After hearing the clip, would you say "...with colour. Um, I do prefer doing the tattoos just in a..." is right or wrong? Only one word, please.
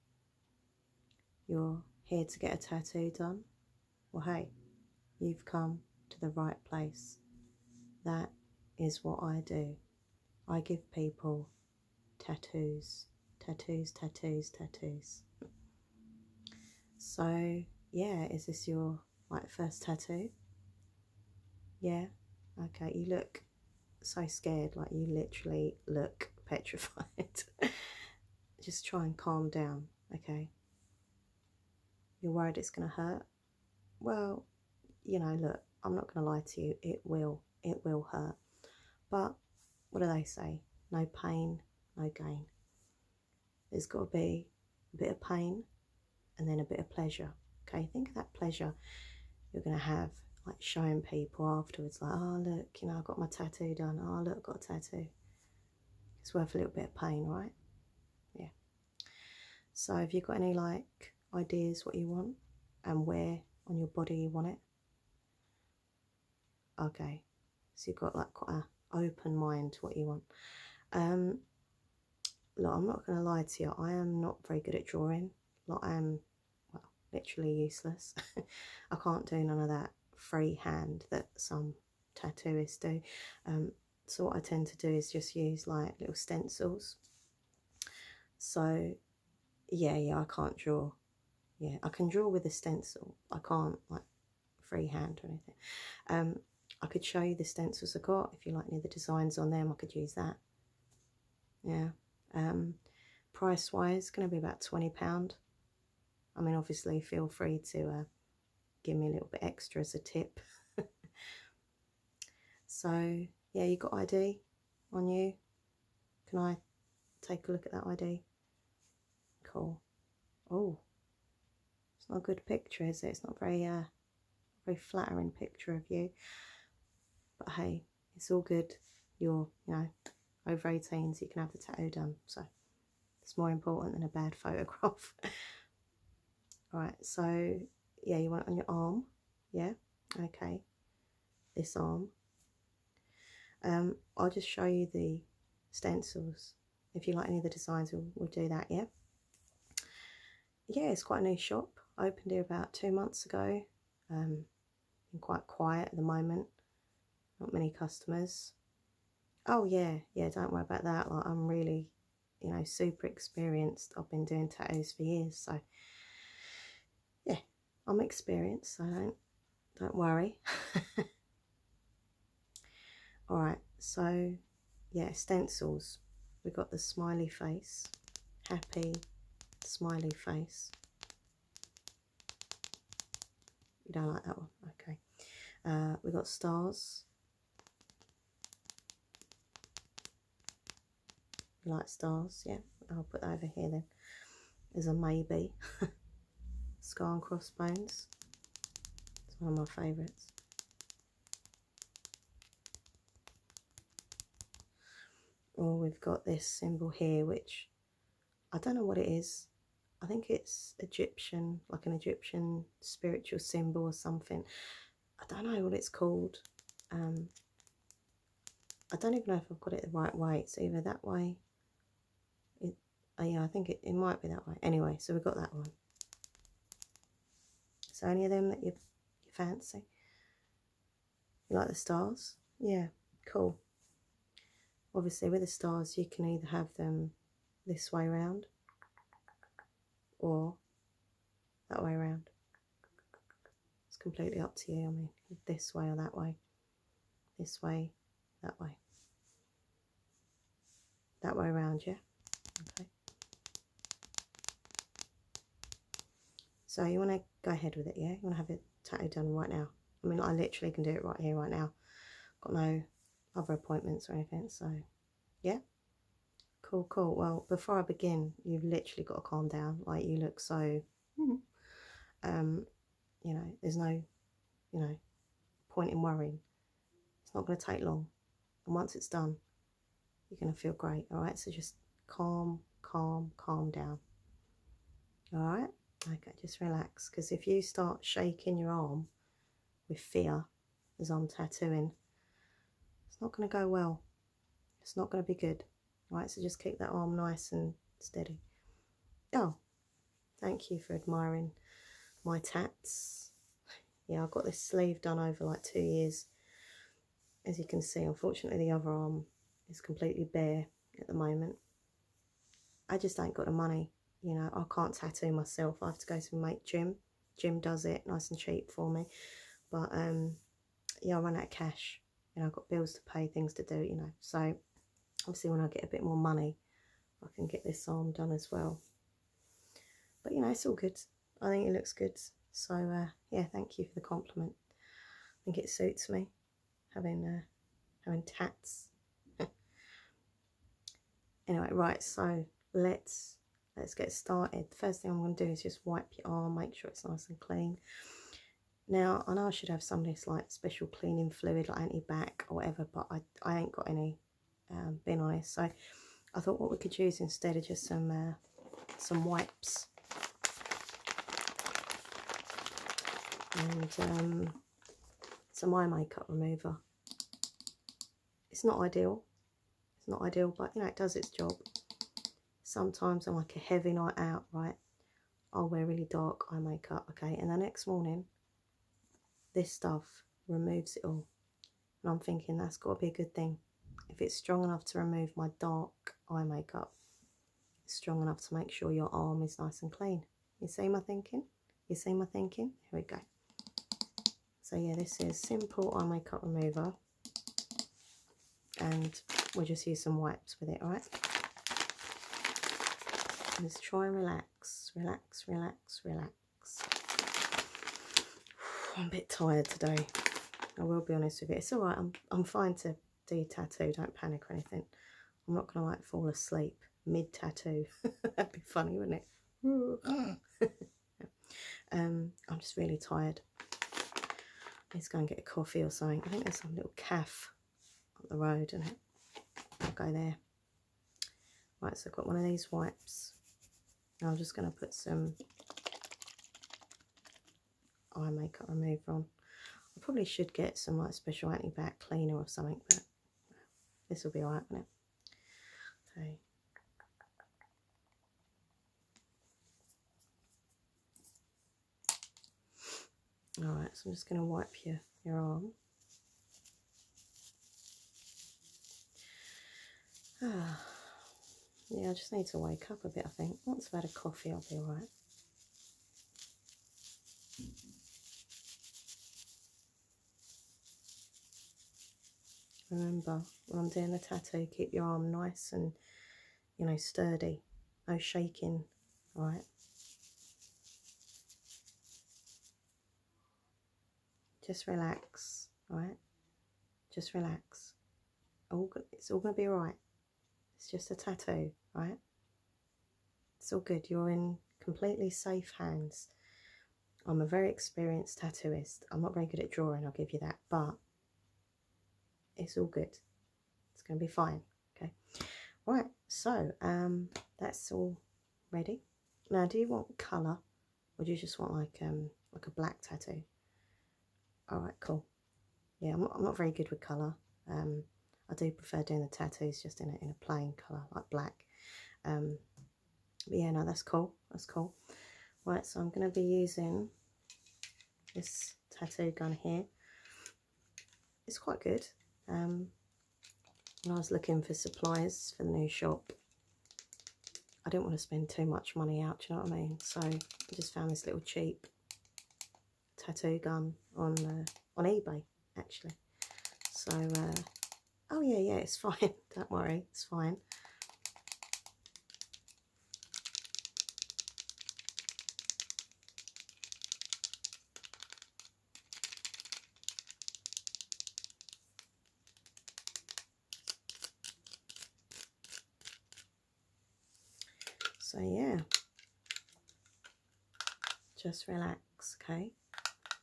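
right.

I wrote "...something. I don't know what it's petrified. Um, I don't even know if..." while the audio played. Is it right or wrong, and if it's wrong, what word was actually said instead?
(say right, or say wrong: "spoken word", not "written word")
wrong: "called", not "petrified".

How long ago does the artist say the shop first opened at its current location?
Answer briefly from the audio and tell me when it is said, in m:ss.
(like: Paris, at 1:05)
two months ago, at 2:32.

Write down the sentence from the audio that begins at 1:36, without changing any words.
Um, I could show you the stencils I got.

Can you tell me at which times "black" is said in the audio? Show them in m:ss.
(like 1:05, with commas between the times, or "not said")
8:32, 8:41.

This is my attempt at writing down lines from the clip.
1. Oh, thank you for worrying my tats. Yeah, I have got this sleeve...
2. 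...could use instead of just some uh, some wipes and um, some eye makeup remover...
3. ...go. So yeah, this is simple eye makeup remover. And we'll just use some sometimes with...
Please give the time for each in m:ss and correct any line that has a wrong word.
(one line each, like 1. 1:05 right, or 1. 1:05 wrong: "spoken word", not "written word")
1. 4:59 wrong: "admiring", not "worrying"
2. 5:56 right
3. 6:33 wrong: "wipes", not "sometimes".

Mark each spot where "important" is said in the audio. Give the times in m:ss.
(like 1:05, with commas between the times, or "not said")
2:13.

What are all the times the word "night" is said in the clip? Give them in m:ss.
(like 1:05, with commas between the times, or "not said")
6:13.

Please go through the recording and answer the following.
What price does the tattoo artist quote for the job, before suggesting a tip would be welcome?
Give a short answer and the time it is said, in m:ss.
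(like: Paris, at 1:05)
£20, at 1:44.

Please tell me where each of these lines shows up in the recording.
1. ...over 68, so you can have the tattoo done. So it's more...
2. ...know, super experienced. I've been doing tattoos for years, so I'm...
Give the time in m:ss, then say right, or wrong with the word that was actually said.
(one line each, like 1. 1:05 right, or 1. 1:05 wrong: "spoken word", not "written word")
1. 2:10 wrong: "18", not "68"
2. 2:42 right.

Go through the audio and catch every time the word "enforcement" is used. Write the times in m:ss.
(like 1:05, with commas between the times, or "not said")
not said.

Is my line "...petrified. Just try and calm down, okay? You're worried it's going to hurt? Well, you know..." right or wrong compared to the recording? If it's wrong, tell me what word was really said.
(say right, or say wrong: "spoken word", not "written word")
right.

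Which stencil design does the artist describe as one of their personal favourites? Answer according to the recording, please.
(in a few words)
Skull and Crossbones.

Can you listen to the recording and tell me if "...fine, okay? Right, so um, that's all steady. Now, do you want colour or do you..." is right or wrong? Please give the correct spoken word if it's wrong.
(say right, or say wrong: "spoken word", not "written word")
wrong: "ready", not "steady".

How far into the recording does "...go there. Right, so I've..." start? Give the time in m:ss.
7:09.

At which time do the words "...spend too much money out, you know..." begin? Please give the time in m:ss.
8:58.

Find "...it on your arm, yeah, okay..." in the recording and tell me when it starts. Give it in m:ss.
2:18.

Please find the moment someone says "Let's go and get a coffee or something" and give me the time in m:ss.
7:04.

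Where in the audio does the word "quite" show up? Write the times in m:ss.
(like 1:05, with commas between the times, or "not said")
1:08, 2:31, 2:35, 8:51.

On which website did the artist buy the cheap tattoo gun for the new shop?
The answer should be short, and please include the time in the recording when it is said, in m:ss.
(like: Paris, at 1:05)
eBay, at 9:05.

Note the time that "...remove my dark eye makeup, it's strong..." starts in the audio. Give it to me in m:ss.
6:24.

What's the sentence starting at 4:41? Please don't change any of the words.
So just calm, calm, calm down.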